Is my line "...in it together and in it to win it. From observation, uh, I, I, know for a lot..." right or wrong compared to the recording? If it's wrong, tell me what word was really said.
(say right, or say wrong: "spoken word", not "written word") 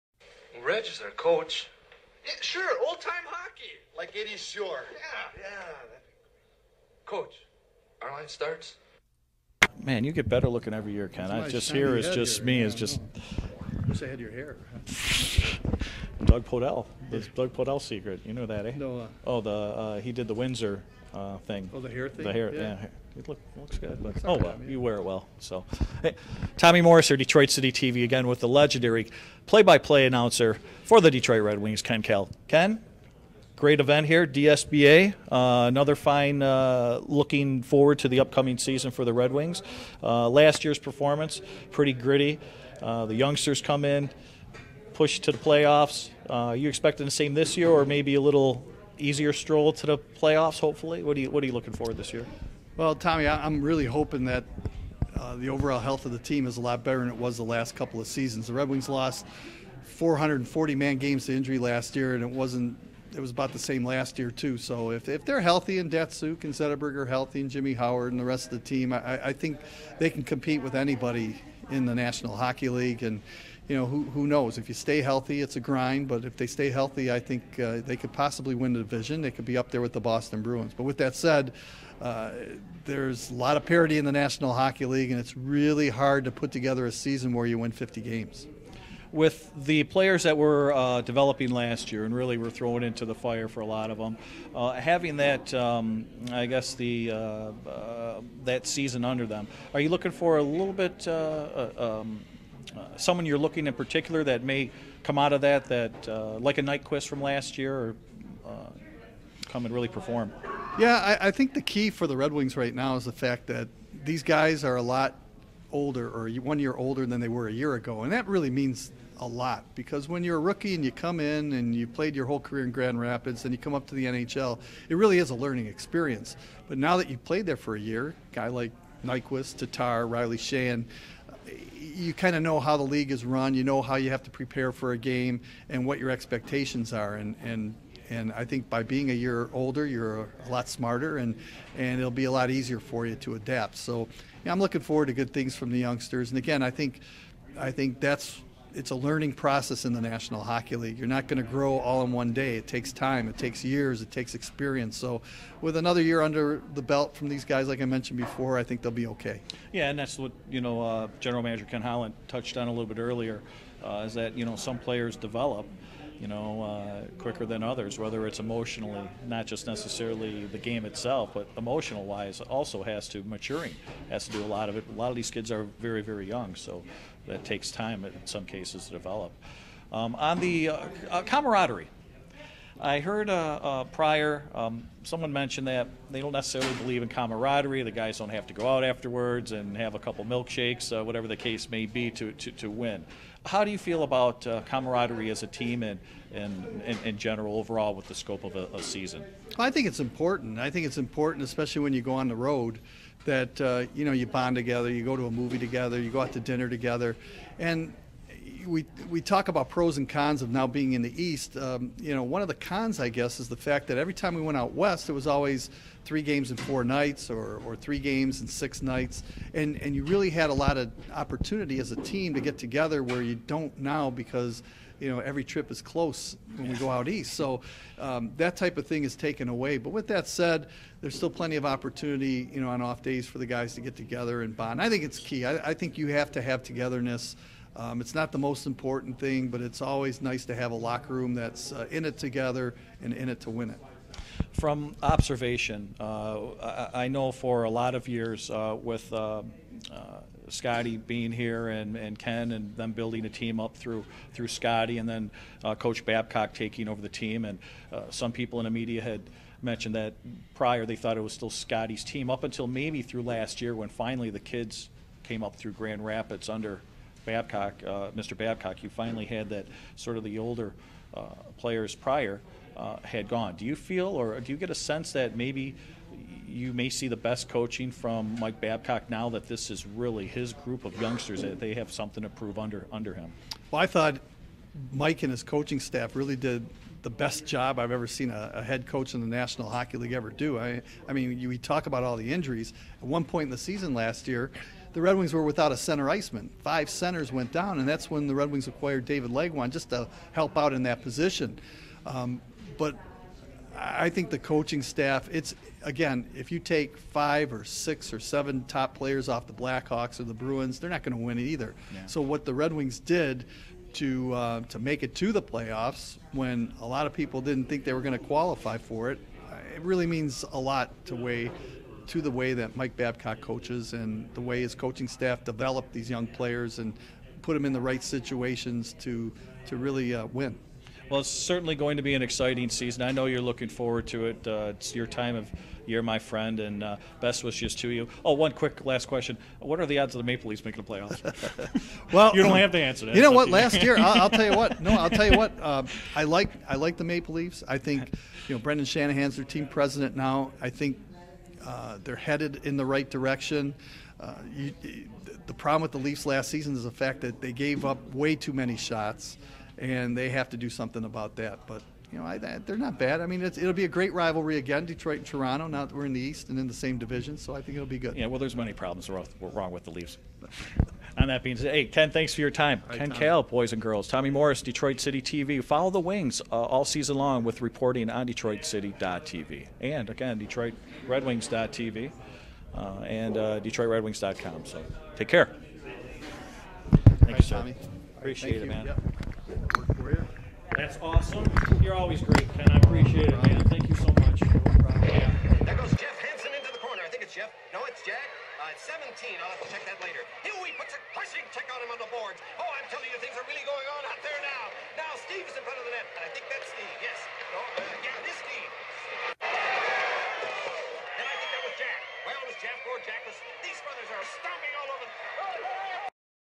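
right.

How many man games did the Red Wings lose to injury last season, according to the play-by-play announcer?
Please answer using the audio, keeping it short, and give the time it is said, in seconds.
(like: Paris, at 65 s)
440, at 59 s.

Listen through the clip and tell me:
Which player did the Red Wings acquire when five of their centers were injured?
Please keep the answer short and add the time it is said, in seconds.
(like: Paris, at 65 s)
David Legwand, at 299 s.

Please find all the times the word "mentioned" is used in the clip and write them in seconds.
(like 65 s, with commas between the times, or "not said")
157 s, 185 s, 259 s.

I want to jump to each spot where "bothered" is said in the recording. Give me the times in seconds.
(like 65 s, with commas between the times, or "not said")
not said.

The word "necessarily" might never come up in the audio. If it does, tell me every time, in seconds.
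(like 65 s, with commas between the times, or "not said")
169 s, 186 s.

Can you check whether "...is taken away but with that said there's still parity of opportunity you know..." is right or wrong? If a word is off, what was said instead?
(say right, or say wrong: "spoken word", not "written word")
wrong: "plenty", not "parity".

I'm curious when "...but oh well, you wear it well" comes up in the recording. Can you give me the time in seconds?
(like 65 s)
24 s.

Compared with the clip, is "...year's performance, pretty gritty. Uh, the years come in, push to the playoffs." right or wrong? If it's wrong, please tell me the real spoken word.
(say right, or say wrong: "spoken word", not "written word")
wrong: "youngsters", not "years".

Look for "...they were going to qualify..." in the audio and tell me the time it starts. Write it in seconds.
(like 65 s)
317 s.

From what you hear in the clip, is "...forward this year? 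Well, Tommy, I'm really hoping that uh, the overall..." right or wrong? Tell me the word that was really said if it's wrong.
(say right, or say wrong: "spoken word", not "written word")
right.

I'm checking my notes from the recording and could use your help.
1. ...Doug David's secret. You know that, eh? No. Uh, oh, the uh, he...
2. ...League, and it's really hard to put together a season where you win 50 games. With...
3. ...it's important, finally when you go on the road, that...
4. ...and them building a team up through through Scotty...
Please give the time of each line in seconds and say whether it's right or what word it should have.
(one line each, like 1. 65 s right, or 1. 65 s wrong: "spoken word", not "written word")
1. 17 s wrong: "Podell", not "David"
2. 84 s right
3. 200 s wrong: "especially", not "finally"
4. 252 s right.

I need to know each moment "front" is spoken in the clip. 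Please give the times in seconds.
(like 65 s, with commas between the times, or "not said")
405 s.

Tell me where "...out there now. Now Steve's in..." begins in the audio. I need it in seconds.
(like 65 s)
404 s.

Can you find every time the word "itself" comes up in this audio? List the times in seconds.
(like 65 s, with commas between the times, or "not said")
170 s.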